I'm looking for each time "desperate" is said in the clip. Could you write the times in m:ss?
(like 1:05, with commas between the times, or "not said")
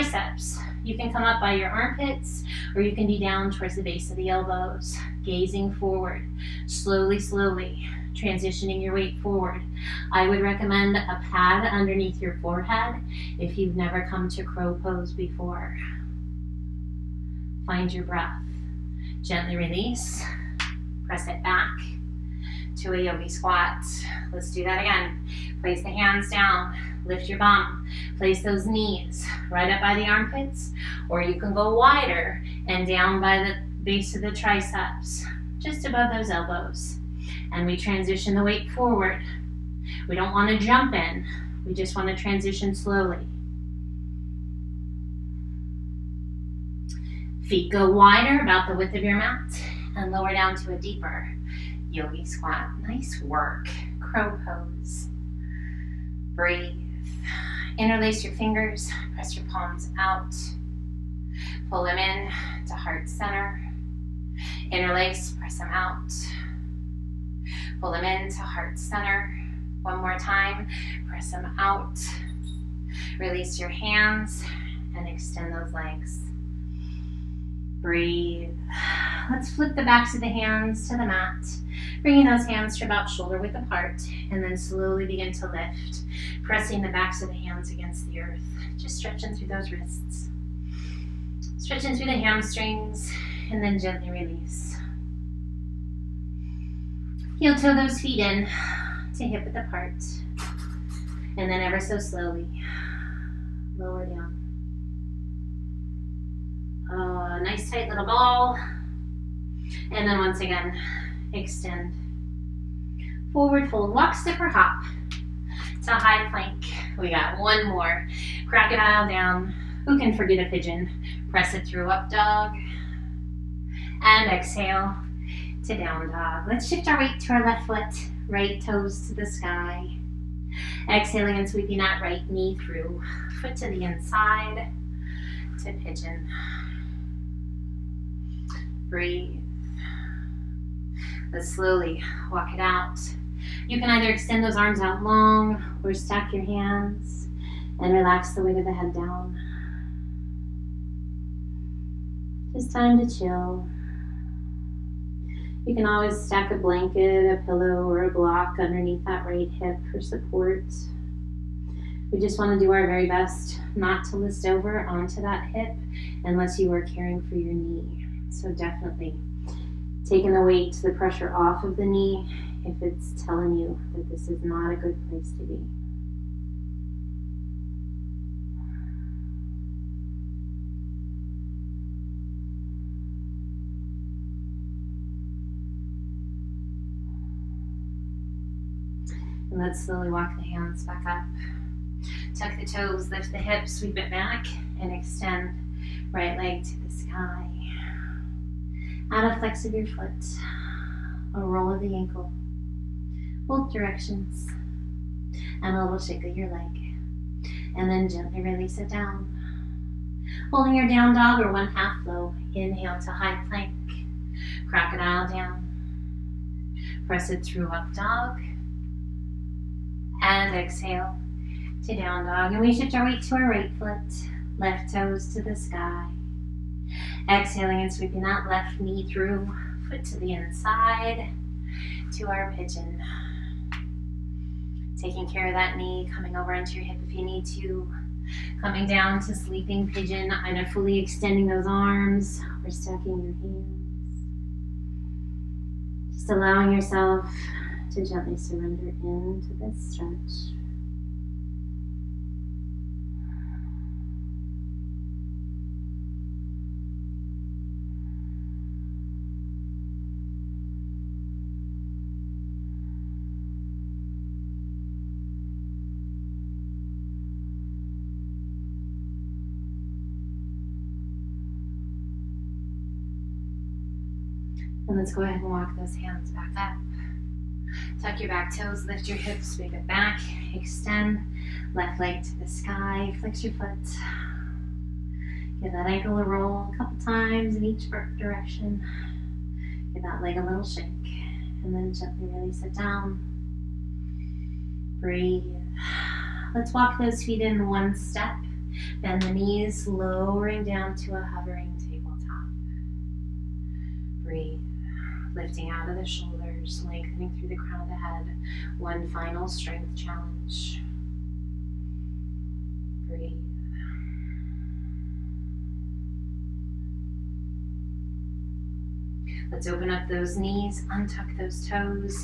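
not said.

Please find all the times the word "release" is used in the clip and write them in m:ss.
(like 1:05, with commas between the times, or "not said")
0:19, 1:13, 1:34, 3:28, 4:52.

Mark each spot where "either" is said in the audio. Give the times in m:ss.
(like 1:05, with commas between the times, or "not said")
2:23, 4:00.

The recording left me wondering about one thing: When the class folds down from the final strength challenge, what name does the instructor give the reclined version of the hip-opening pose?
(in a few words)
Sleeping pigeon.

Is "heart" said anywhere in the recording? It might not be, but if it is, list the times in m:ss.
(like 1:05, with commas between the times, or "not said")
1:02, 1:08.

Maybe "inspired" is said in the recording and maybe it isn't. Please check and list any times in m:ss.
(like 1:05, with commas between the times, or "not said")
not said.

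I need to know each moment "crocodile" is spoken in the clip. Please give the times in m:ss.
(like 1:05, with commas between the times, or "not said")
1:58, 3:34.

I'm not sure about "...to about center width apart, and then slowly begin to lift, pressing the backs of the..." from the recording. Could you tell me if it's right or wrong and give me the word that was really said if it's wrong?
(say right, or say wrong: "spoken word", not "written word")
wrong: "shoulder", not "center".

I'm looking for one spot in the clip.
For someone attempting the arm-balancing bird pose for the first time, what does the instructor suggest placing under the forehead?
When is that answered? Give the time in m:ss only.
0:10.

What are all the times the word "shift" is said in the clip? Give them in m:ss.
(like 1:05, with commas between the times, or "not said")
2:06, 3:42.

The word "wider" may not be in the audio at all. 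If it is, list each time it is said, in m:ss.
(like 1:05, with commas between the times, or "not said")
0:31, 0:47.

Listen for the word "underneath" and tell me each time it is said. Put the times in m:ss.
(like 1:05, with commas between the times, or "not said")
0:11, 2:38.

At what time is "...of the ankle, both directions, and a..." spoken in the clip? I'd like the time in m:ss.
3:21.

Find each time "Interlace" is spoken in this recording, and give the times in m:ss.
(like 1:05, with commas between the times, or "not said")
0:57, 1:04.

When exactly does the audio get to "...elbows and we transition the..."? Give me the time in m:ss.
0:36.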